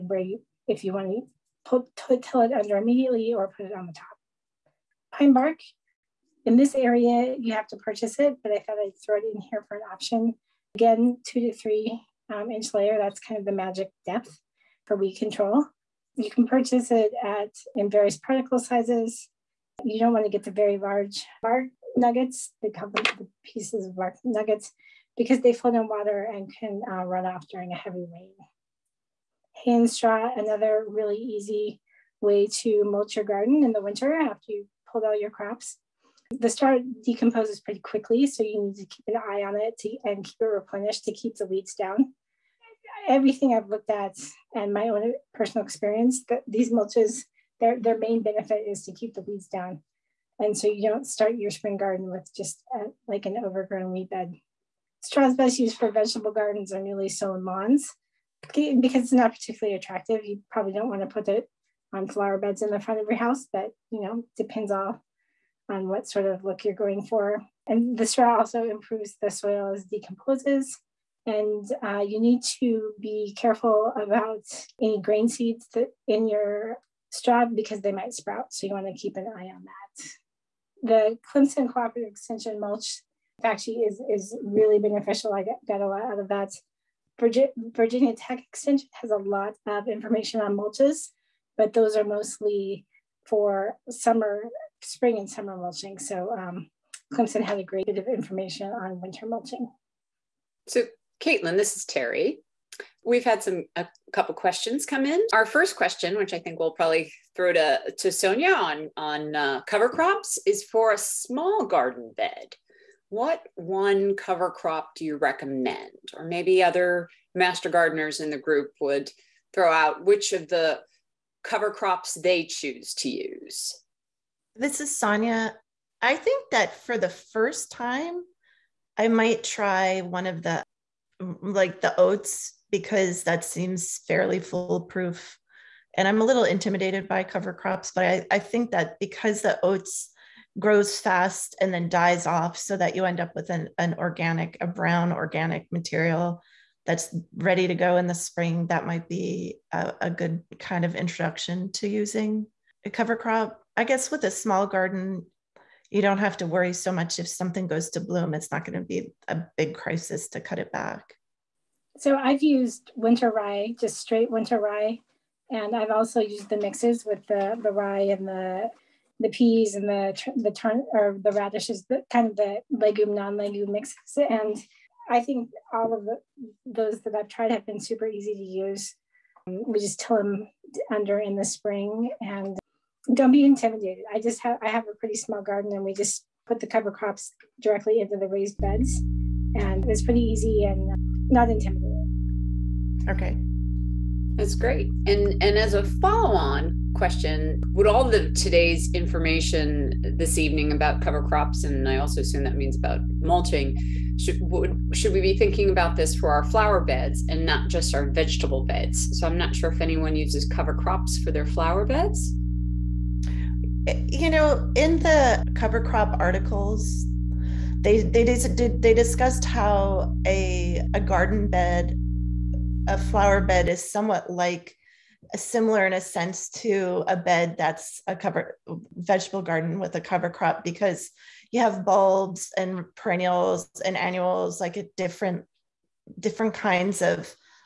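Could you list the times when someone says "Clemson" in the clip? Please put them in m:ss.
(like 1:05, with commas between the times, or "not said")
1:21, 1:37.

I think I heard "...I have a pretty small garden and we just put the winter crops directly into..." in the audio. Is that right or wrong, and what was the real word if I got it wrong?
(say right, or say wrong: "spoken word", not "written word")
wrong: "cover", not "winter".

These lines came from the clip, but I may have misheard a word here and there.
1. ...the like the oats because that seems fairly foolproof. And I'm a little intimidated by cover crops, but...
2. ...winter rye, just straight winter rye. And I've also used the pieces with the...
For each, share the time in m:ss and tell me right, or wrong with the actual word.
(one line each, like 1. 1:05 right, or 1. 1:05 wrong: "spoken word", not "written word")
1. 2:10 right
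2. 2:42 wrong: "mixes", not "pieces".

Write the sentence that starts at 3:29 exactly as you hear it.
So I'm not sure if anyone uses cover crops for their flower beds.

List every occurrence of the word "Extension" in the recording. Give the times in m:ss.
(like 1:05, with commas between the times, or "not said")
1:22, 1:28.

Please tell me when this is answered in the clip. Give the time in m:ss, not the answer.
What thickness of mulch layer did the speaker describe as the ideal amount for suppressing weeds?
0:11.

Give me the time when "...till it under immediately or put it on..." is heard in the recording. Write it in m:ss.
0:01.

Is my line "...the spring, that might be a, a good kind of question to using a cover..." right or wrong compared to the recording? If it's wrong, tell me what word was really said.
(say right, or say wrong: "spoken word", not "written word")
wrong: "introduction", not "question".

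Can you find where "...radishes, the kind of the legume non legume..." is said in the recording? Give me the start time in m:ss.
2:51.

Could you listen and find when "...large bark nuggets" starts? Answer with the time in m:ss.
0:20.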